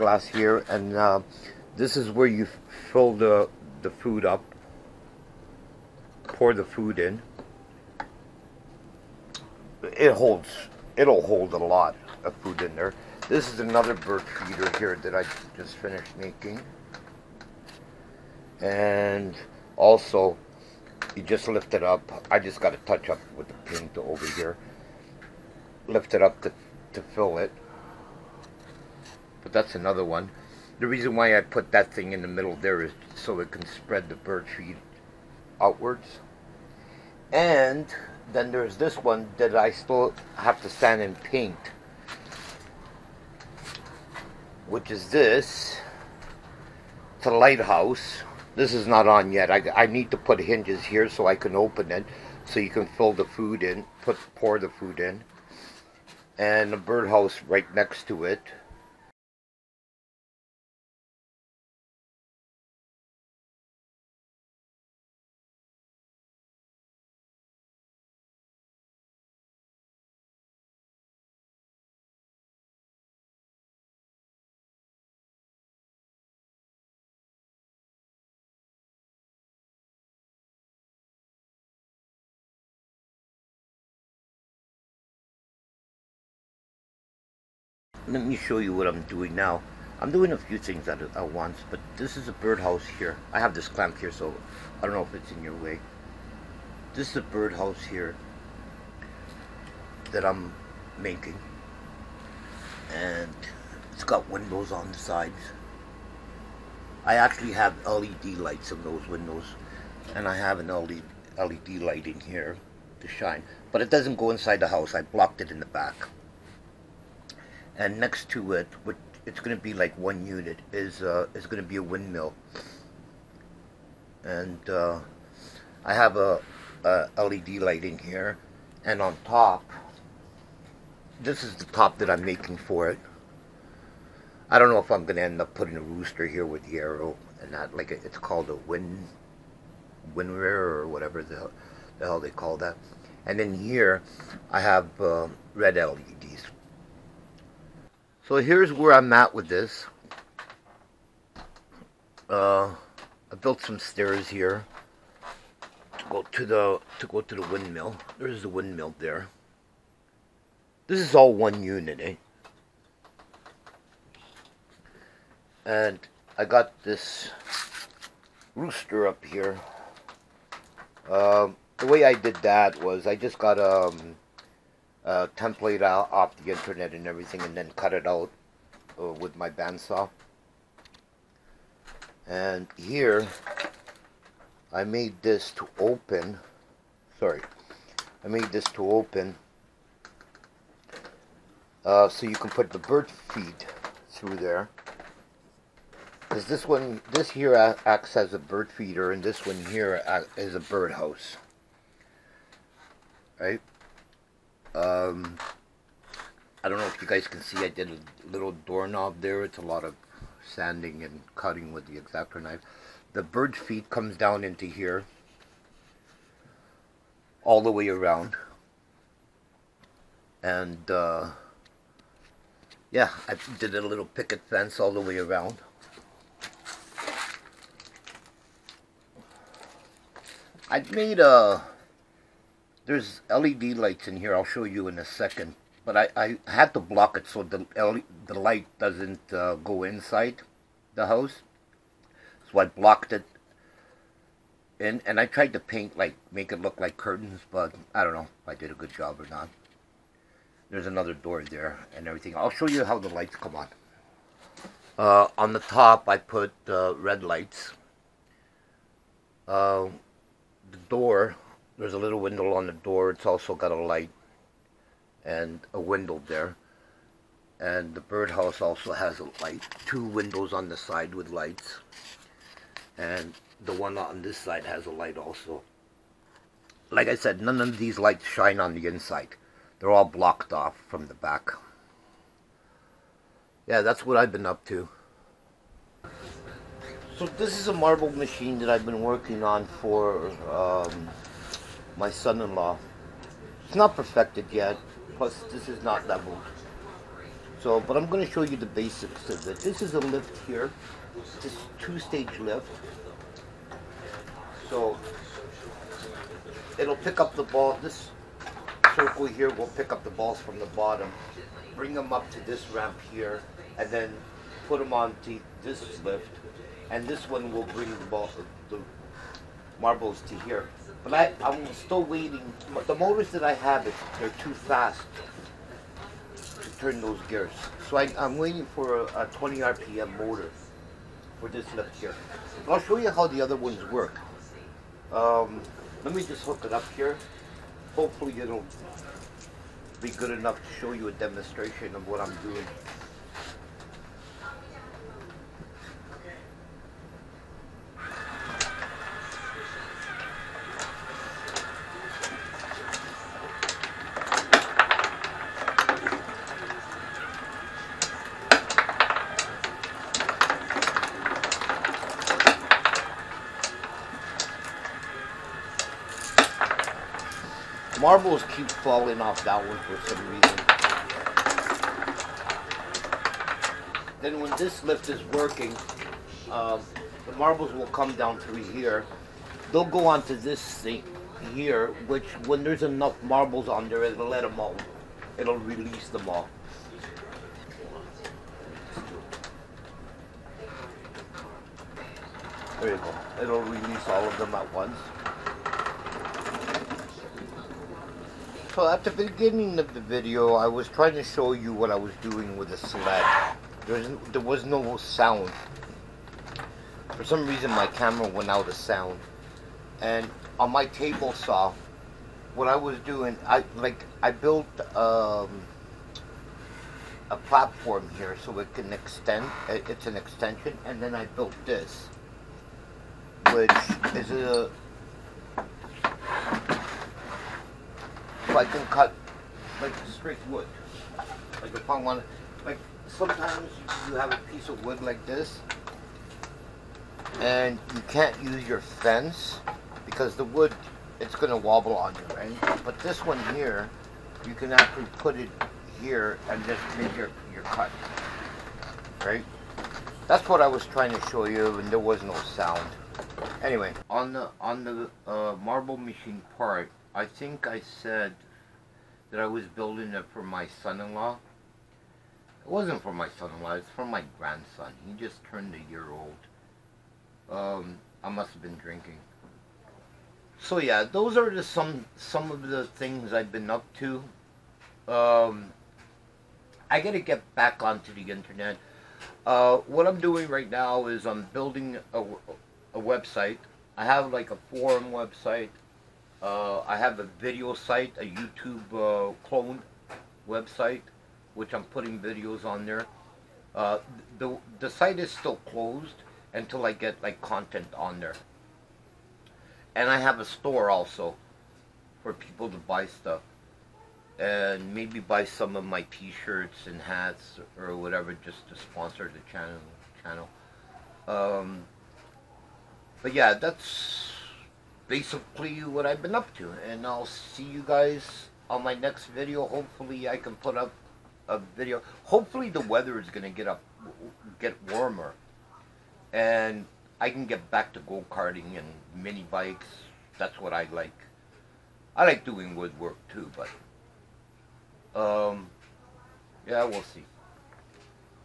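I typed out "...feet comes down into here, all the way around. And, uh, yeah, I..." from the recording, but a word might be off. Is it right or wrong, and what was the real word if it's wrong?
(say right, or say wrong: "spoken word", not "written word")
right.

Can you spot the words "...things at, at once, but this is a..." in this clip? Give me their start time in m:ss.
1:30.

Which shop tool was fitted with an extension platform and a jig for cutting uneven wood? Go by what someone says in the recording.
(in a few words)
Table saw.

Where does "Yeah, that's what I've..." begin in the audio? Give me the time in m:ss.
4:43.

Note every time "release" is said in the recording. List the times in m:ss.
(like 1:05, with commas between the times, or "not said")
6:25, 6:33.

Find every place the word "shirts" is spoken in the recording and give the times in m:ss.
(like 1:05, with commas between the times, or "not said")
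8:26.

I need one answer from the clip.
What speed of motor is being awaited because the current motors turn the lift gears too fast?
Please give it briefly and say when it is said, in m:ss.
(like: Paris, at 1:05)
20 RPM, at 5:29.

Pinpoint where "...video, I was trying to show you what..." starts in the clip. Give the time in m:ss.
6:40.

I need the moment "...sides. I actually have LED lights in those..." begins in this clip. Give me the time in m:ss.
1:44.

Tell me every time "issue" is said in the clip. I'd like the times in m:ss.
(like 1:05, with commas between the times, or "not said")
not said.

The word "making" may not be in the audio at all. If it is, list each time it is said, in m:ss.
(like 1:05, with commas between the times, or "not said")
0:16, 1:40, 2:12.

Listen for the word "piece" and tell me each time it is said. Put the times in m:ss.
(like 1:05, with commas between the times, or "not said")
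7:14.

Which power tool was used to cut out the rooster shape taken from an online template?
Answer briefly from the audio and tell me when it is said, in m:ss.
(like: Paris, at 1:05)
Bandsaw, at 2:59.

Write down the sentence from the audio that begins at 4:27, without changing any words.
And the birdhouse also has a light.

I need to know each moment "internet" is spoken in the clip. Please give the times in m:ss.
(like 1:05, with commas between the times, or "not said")
2:56, 7:58.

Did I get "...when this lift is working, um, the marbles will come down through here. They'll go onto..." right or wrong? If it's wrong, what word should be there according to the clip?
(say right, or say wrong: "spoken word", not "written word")
right.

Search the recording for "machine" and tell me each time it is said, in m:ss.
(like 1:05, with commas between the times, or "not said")
4:48, 7:35.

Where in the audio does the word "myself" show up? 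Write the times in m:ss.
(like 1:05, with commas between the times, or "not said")
not said.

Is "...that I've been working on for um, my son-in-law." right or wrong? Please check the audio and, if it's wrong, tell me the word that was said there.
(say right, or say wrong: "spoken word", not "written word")
right.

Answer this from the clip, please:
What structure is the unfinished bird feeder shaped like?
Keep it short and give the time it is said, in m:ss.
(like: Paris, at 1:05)
A lighthouse, at 0:47.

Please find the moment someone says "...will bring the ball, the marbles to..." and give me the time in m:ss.
5:17.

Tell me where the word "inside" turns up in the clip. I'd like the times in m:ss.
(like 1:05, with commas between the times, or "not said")
1:54, 3:59, 4:38.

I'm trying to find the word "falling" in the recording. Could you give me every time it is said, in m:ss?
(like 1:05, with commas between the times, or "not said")
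6:08.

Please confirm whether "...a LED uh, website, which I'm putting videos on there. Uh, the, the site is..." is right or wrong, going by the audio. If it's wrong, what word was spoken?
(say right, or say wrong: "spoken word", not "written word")
wrong: "YouTube", not "LED".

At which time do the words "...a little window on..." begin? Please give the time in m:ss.
4:21.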